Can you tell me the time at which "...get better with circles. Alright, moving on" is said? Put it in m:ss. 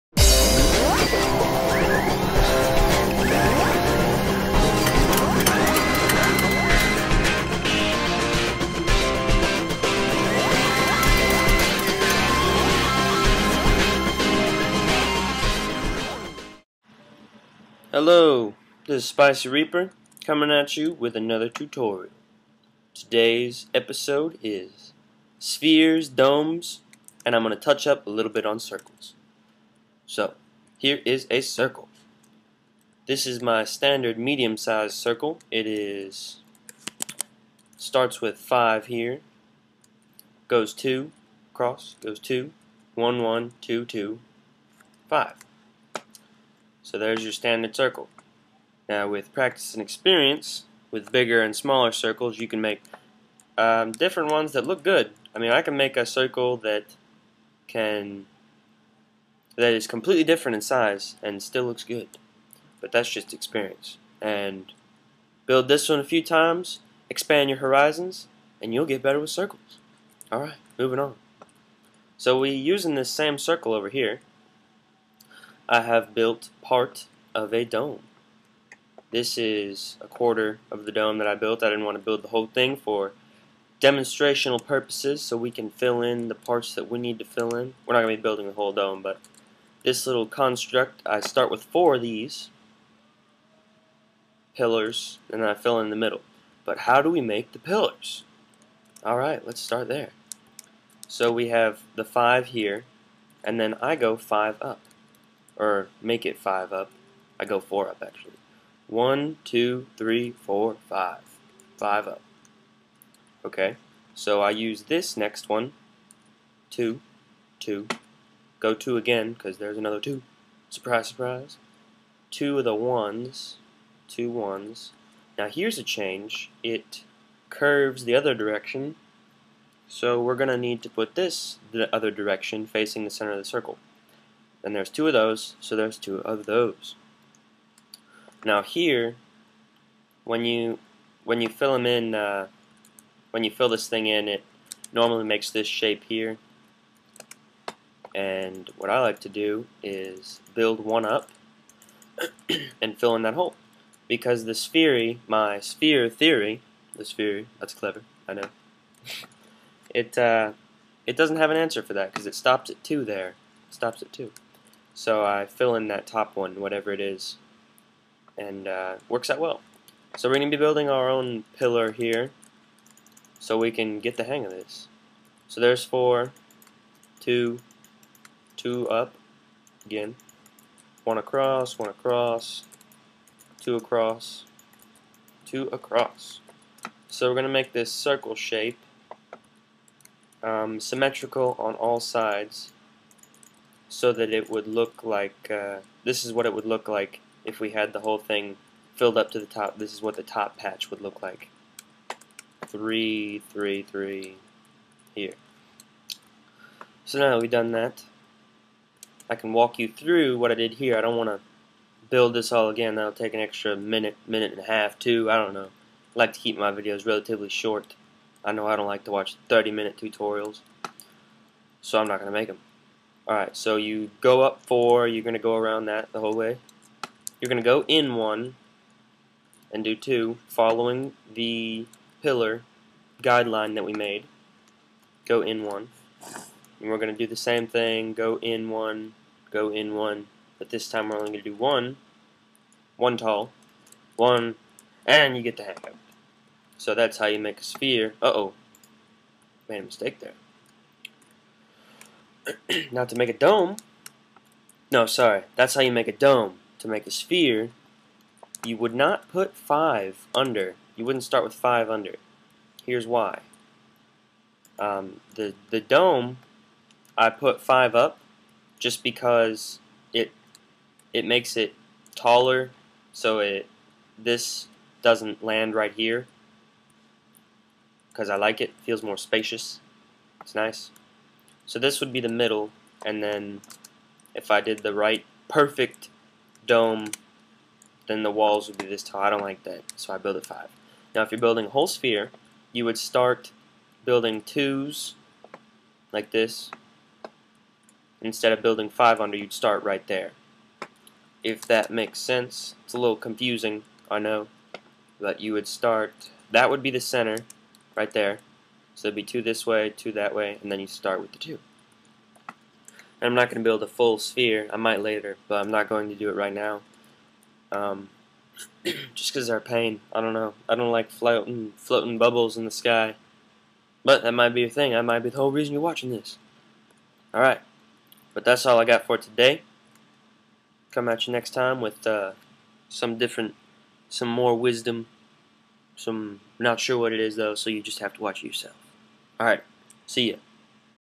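1:08.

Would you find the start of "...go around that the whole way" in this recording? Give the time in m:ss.
3:45.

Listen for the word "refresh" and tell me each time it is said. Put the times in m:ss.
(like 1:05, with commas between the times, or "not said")
not said.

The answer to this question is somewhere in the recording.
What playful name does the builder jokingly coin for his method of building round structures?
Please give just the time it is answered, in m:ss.
2:35.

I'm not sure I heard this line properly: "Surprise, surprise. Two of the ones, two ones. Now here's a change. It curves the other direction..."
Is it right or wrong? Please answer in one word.
right.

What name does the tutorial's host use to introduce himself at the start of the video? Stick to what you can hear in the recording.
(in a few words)
Spicy Reaper.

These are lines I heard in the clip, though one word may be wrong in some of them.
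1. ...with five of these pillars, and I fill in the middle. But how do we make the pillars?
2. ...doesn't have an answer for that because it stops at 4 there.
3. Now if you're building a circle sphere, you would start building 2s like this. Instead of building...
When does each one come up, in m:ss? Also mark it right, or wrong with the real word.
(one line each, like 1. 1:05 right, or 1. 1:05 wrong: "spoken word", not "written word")
1. 1:31 wrong: "four", not "five"
2. 2:41 wrong: "2", not "4"
3. 4:51 wrong: "whole", not "circle".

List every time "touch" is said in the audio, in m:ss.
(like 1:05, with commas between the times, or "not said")
0:27.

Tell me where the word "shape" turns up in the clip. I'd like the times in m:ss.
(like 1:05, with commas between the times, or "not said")
2:25, 3:08.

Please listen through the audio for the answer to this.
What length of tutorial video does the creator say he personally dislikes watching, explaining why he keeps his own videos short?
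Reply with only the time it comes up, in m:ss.
3:39.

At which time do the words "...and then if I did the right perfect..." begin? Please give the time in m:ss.
4:43.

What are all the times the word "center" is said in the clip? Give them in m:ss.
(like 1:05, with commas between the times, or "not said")
2:13, 5:06.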